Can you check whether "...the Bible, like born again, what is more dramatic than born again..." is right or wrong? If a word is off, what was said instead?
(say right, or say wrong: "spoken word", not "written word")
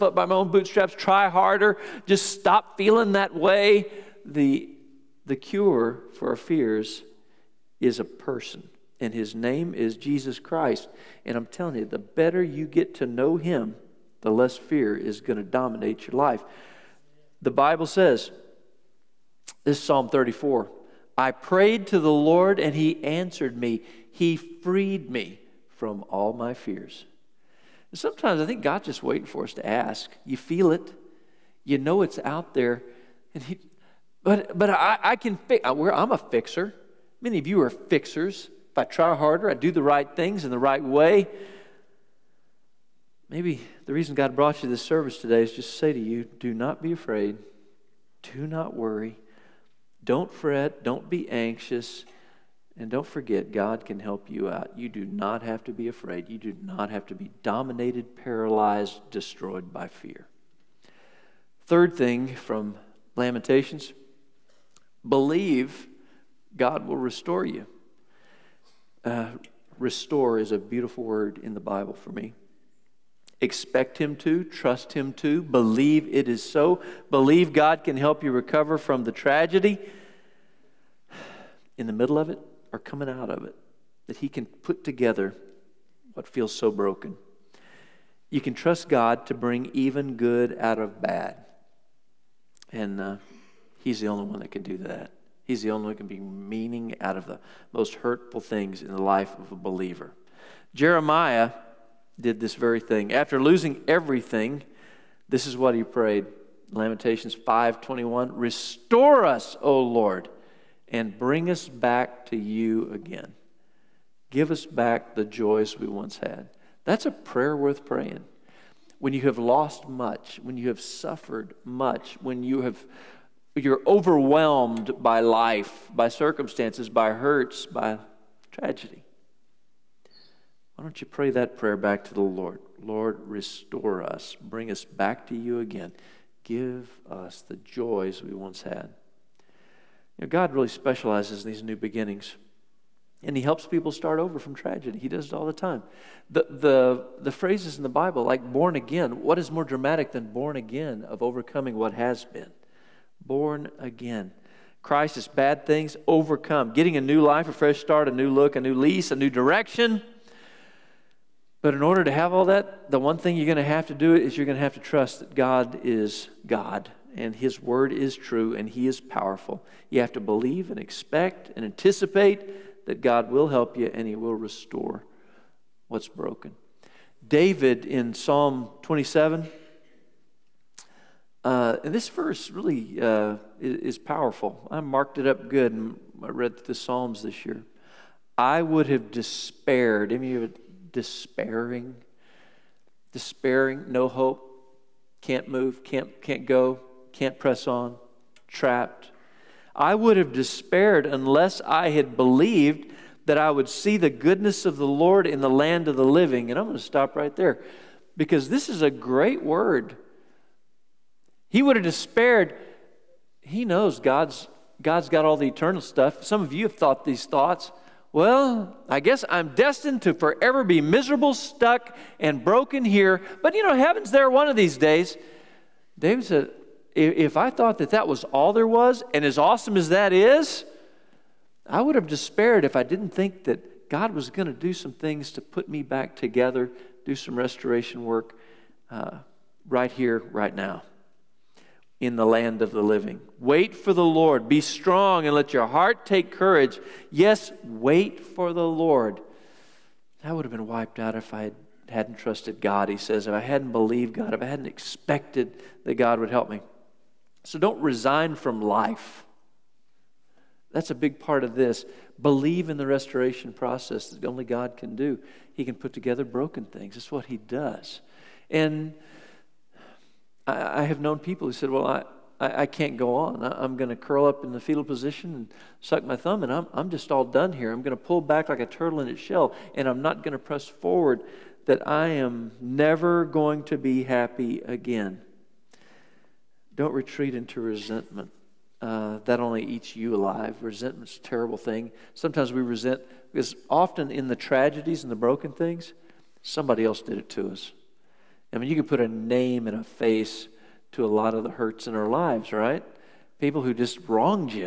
right.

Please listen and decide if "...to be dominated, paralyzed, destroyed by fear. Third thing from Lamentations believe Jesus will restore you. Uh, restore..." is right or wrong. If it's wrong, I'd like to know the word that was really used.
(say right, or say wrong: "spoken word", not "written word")
wrong: "God", not "Jesus".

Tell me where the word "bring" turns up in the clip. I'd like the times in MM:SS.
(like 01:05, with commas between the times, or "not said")
01:29, 01:51, 02:14.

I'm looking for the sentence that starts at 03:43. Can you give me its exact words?
But you know, heaven's there one of these days.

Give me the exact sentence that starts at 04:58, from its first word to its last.
I mean, you can put a name and a face to a lot of the hurts in our lives, right?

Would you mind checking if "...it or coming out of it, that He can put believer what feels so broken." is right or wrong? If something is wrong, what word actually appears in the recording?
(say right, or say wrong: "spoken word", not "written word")
wrong: "together", not "believer".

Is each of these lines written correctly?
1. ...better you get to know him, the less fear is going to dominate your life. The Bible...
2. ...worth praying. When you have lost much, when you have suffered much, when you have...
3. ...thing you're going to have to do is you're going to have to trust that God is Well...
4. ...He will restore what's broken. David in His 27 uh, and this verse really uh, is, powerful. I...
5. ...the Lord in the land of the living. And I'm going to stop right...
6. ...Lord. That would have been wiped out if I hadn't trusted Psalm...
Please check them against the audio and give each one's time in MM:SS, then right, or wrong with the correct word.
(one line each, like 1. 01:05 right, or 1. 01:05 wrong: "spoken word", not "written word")
1. 00:11 right
2. 01:57 right
3. 02:43 wrong: "God", not "Well"
4. 02:54 wrong: "Psalm", not "His"
5. 03:24 right
6. 04:08 wrong: "God", not "Psalm".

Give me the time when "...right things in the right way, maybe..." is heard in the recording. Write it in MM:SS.
00:39.